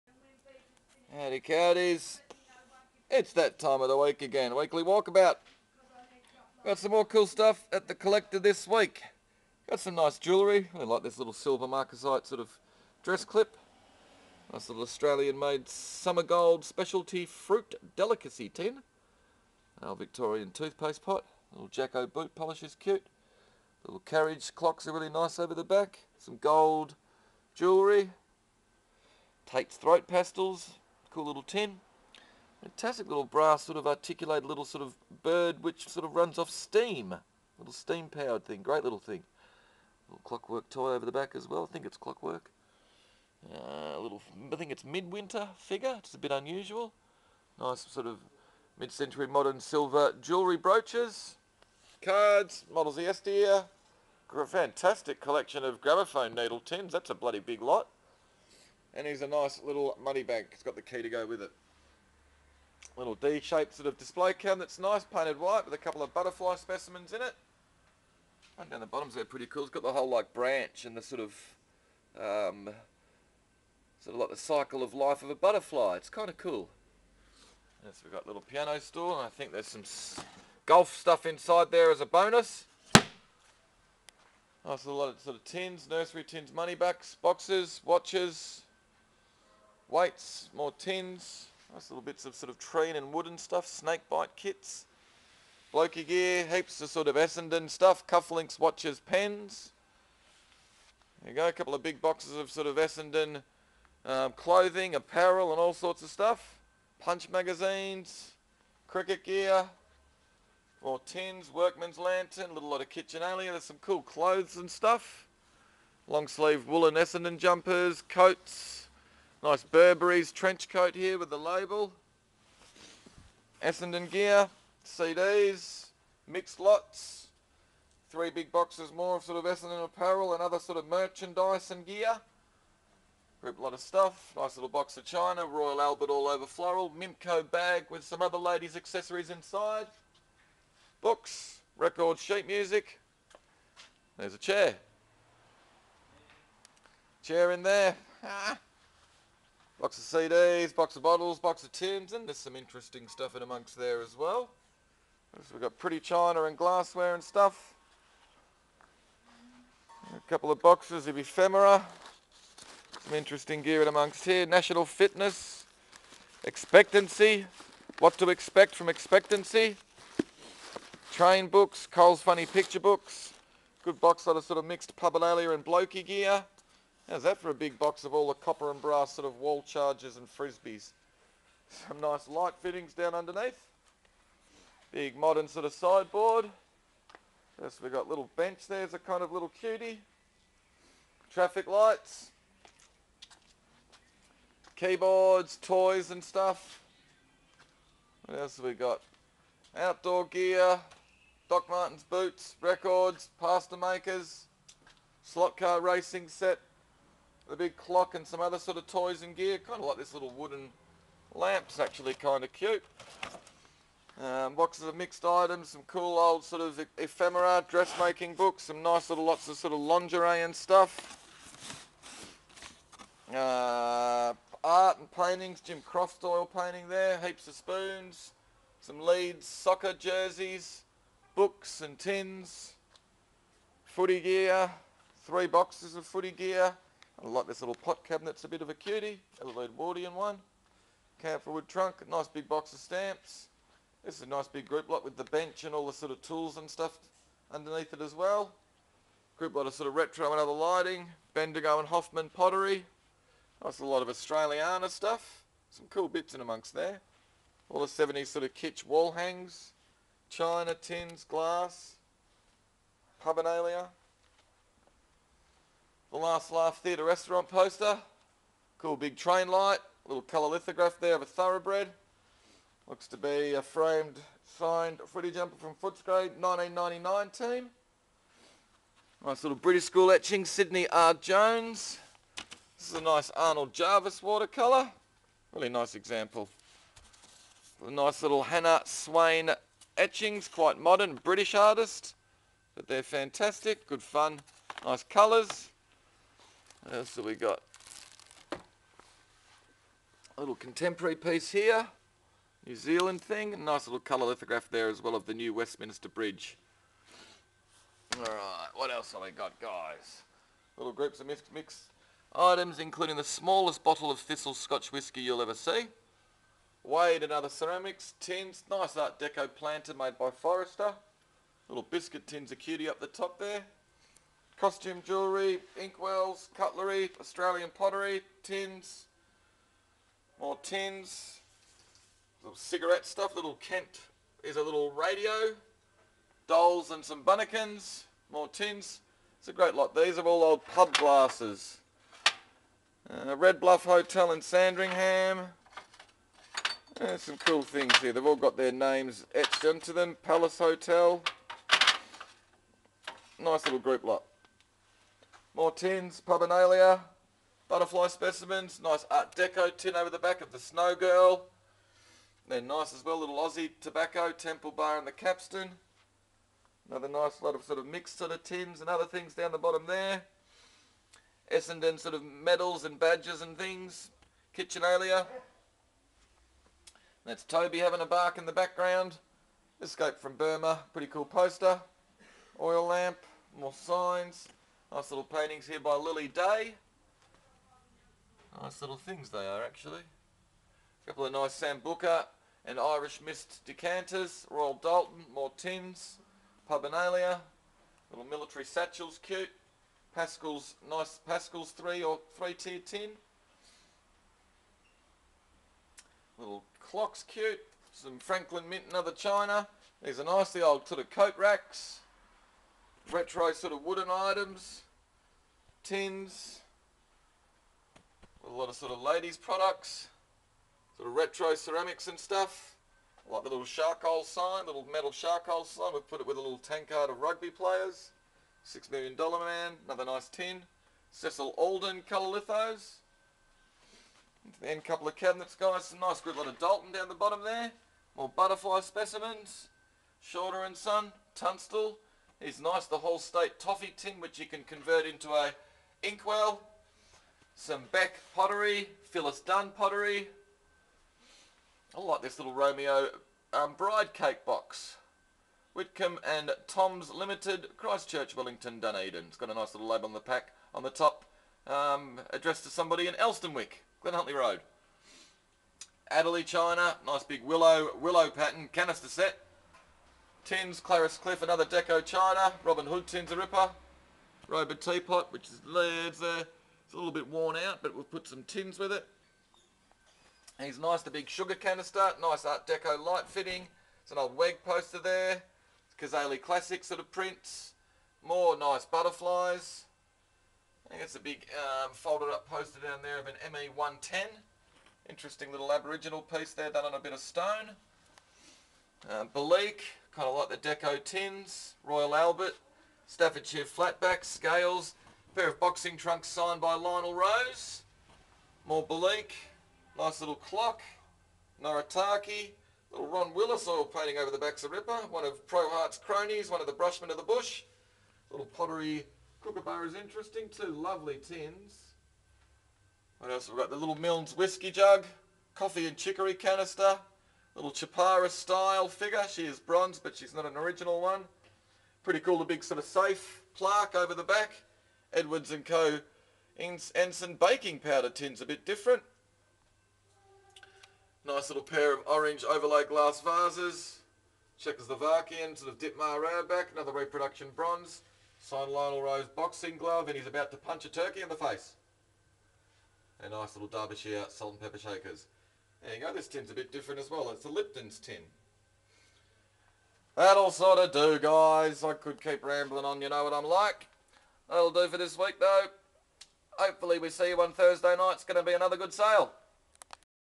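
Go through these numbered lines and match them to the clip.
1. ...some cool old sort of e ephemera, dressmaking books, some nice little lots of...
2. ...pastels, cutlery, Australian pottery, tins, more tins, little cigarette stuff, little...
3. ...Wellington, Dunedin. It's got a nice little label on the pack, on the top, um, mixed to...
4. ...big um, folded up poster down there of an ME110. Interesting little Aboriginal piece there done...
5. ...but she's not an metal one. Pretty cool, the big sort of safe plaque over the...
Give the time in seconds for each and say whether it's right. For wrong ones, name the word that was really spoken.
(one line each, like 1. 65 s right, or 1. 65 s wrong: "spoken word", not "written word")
1. 215 s right
2. 325 s wrong: "inkwells", not "pastels"
3. 458 s wrong: "addressed", not "mixed"
4. 491 s right
5. 529 s wrong: "original", not "metal".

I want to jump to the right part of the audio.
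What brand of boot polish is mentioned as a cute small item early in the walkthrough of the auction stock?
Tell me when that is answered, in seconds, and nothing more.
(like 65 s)
21 s.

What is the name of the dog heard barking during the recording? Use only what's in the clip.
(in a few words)
Toby.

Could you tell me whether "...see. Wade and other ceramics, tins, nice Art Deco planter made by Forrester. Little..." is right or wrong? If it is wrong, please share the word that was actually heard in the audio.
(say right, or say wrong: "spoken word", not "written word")
right.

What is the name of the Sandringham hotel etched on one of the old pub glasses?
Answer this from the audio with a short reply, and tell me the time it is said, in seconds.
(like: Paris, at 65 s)
Red Bluff Hotel, at 343 s.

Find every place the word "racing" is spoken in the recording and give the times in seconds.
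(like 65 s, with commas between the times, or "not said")
205 s.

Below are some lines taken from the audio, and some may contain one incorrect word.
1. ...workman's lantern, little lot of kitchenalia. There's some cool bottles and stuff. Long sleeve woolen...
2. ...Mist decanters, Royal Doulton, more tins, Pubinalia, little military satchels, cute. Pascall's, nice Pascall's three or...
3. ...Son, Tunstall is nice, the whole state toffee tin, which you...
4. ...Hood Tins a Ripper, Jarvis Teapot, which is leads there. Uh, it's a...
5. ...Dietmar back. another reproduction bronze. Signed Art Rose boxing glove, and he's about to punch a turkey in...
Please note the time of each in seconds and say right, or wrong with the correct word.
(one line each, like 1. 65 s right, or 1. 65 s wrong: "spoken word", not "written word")
1. 111 s wrong: "clothes", not "bottles"
2. 393 s right
3. 440 s right
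4. 472 s wrong: "Robert", not "Jarvis"
5. 545 s wrong: "Lionel", not "Art".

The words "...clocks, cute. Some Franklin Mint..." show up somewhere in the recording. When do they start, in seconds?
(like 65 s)
406 s.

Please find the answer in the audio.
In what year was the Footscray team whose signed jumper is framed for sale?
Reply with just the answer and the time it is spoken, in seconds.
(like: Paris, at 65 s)
1999, at 276 s.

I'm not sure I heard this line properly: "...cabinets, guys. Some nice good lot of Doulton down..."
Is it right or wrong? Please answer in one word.
right.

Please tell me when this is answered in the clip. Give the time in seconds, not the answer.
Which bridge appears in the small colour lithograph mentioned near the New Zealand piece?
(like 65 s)
305 s.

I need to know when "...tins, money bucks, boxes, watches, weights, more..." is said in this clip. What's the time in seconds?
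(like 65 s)
86 s.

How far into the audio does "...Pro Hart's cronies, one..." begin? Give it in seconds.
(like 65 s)
515 s.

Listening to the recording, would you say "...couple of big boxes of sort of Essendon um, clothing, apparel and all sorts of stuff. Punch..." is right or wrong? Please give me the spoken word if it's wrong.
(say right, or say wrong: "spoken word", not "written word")
right.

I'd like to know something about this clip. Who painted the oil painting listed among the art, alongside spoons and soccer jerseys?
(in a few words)
Jim Croft.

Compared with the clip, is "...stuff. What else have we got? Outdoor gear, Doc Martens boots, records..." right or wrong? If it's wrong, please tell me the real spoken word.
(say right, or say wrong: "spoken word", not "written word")
right.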